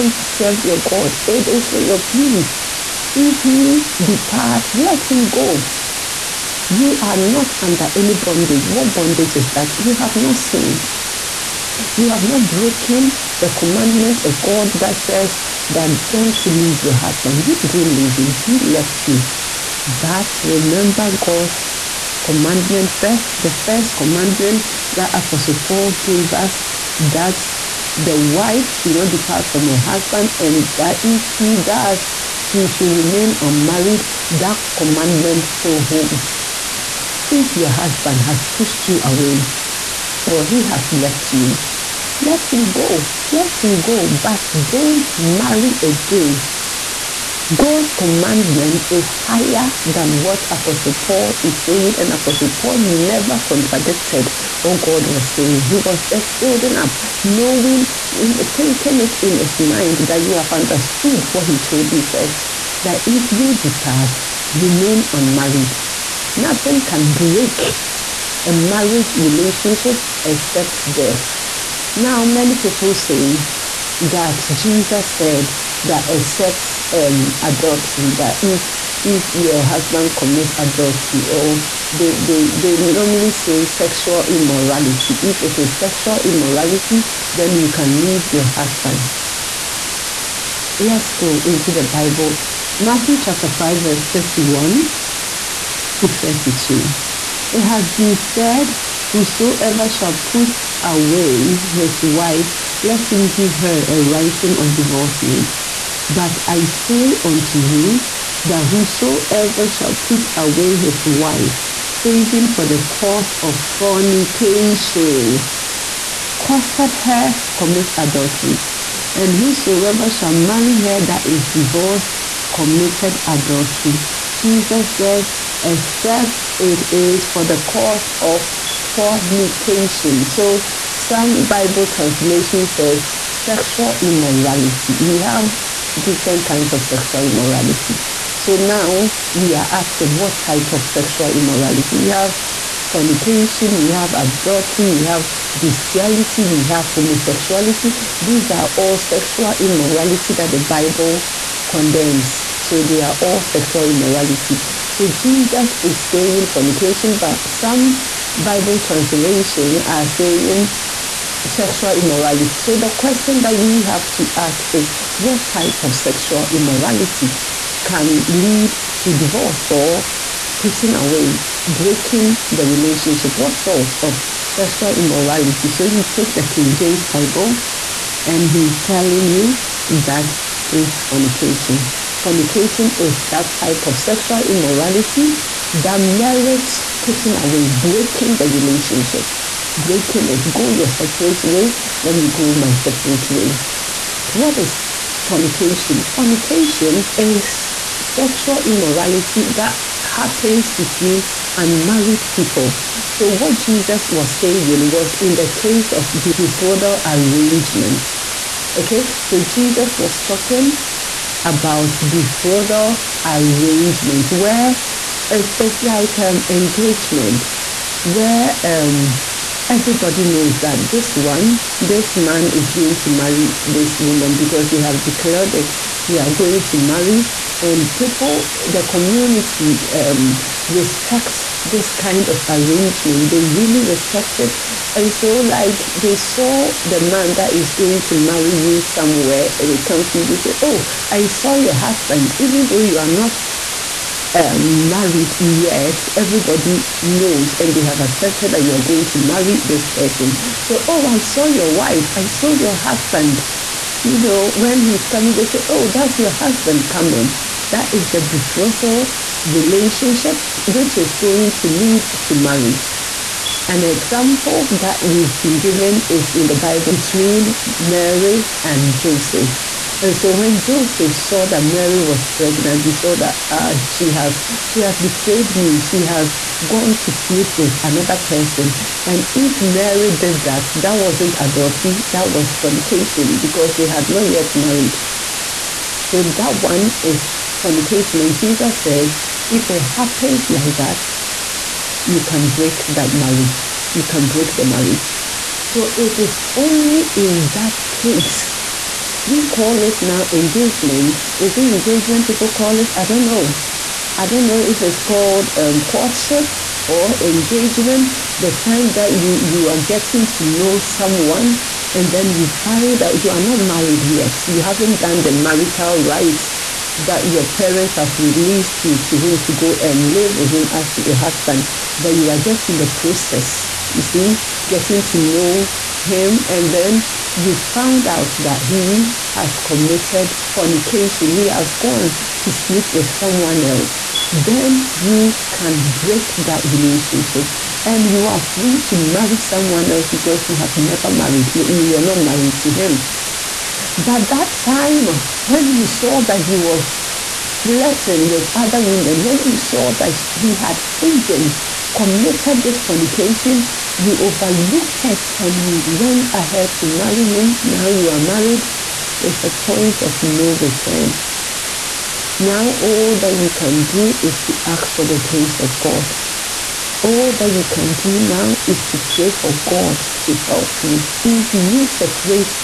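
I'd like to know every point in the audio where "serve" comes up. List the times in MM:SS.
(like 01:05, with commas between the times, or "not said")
00:00.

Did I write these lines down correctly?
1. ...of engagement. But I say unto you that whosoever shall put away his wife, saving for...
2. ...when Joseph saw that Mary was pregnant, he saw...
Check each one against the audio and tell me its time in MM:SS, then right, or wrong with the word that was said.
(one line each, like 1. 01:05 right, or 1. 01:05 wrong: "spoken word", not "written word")
1. 01:44 wrong: "divorcement", not "engagement"
2. 04:30 right.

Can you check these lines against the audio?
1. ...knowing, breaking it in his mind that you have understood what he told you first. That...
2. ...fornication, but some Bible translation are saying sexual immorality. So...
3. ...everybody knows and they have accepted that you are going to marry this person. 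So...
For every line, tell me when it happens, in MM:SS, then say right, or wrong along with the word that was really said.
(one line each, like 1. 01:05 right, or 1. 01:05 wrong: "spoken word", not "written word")
1. 00:57 wrong: "thinking", not "breaking"
2. 02:36 right
3. 04:06 right.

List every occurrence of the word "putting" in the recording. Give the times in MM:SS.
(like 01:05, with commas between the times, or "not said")
02:50, 03:07.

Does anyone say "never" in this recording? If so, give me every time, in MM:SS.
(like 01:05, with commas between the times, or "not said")
00:52, 05:40.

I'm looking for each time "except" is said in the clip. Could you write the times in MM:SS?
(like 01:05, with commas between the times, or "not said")
01:10, 01:16, 02:05.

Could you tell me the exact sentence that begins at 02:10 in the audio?
So some Bible translation says sexual immorality.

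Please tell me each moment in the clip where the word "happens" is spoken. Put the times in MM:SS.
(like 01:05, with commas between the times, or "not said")
03:20, 04:49.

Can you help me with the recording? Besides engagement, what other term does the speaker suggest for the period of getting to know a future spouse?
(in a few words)
Courtship.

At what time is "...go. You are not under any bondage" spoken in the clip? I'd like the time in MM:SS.
00:05.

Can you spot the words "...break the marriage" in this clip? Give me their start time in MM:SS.
04:54.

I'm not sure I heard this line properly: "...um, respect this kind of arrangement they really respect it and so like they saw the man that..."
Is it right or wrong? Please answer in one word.
right.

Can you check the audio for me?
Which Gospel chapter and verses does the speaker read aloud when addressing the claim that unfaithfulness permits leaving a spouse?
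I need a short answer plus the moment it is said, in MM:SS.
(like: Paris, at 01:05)
Matthew 5:31-32, at 01:32.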